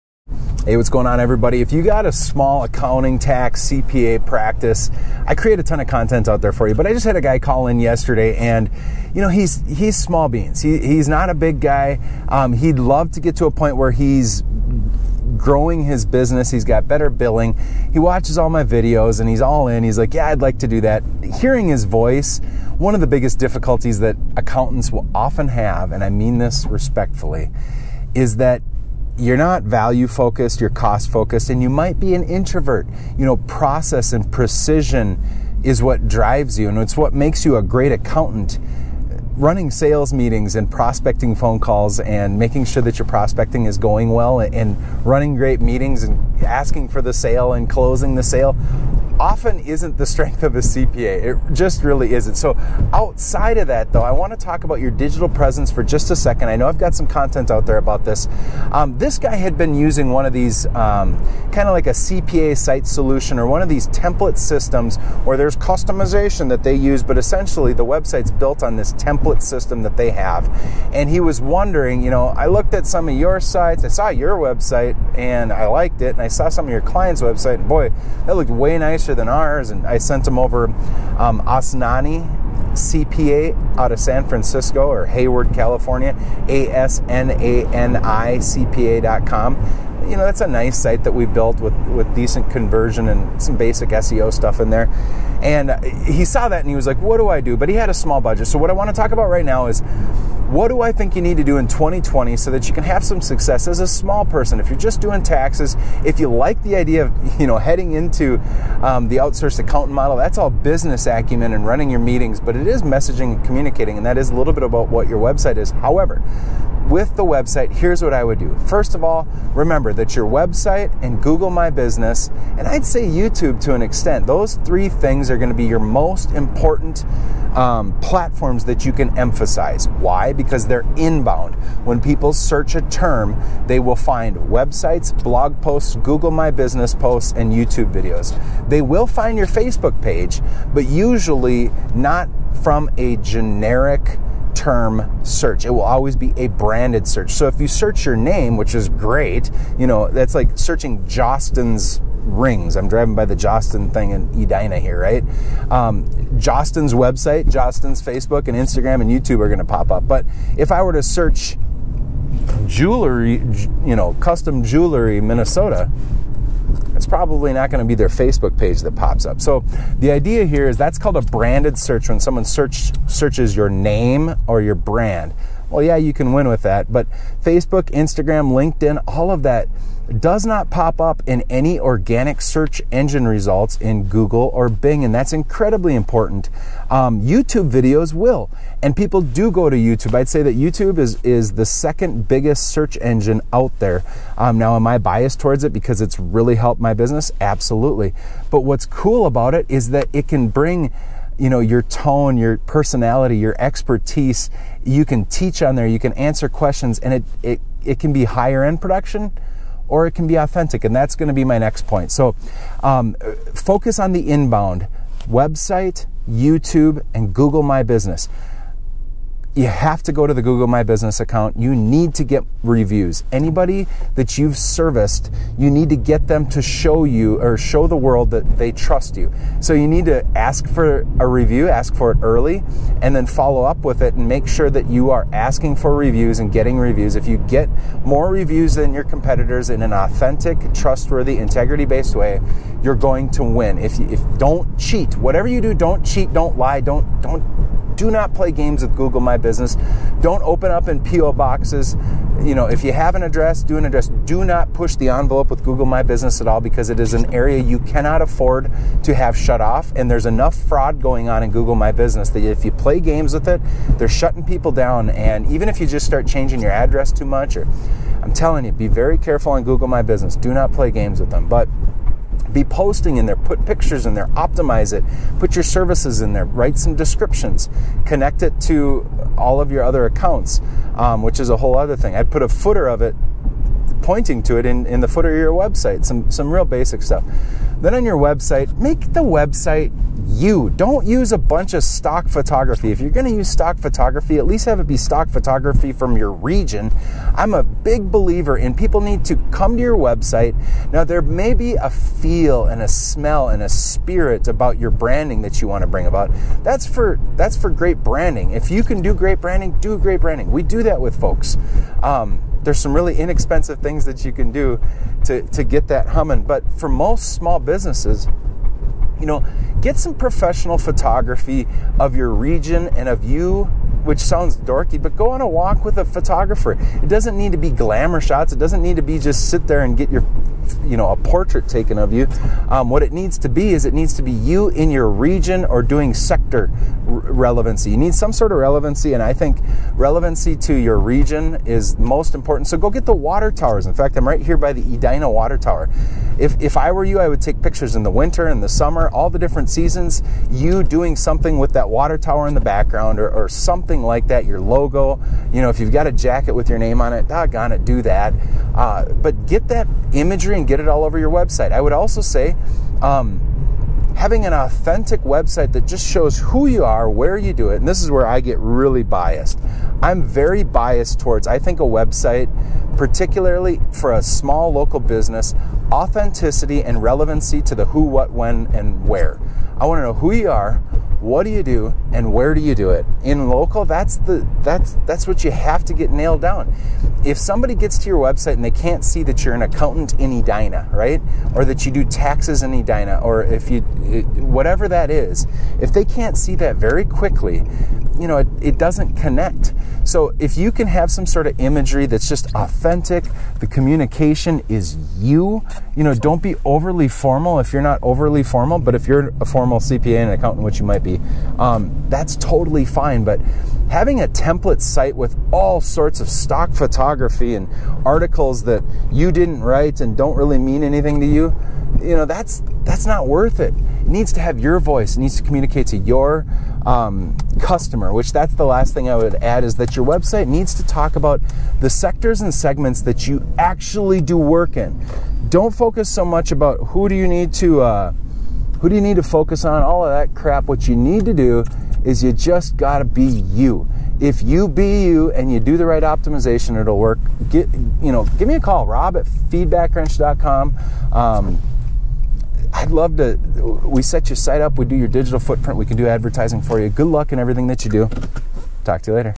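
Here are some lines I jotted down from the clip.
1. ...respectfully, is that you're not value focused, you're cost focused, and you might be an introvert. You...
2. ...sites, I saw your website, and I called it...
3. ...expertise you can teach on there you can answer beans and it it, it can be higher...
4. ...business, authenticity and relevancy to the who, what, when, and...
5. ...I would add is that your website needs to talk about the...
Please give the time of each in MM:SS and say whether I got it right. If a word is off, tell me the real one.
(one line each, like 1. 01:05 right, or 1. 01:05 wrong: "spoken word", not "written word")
1. 00:26 right
2. 01:13 wrong: "liked", not "called"
3. 03:23 wrong: "questions", not "beans"
4. 06:14 right
5. 07:09 right.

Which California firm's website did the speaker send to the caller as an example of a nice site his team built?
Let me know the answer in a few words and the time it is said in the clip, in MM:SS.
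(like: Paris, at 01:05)
Asnani CPA, at 01:21.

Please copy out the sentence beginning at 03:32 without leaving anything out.
So um, focus on the inbound website, YouTube, and Google My Business you have to go to the Google My Business account.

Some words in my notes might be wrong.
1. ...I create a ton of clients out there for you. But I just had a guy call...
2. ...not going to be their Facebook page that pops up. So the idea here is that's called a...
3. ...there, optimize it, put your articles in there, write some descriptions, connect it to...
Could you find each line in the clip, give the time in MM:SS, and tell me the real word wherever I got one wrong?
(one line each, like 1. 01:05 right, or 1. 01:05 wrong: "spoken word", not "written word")
1. 00:05 wrong: "content", not "clients"
2. 02:47 right
3. 04:34 wrong: "services", not "articles".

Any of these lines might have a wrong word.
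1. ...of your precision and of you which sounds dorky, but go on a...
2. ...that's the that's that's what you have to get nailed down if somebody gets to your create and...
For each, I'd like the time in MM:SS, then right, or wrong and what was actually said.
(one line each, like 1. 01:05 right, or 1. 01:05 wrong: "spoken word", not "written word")
1. 05:21 wrong: "region", not "precision"
2. 06:23 wrong: "website", not "create".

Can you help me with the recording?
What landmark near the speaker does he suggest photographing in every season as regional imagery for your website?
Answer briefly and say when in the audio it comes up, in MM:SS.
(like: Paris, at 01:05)
Edina Water Tower, at 05:44.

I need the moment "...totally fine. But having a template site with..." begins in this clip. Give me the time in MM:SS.
06:52.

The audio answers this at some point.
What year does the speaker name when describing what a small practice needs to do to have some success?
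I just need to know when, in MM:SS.
01:41.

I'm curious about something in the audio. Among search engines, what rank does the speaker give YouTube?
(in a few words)
second biggest.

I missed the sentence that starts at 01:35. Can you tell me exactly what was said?
And he saw that and he was like, "What do I do?" But he had a small budget.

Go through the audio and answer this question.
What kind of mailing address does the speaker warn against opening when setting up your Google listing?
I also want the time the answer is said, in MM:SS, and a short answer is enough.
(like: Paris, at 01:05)
P.O. boxes, at 04:11.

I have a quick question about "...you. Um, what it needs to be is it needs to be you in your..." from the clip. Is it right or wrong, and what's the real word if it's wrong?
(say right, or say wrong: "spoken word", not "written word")
right.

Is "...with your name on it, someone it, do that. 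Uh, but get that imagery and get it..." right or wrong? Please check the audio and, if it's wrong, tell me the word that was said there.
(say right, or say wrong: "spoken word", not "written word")
wrong: "doggone", not "someone".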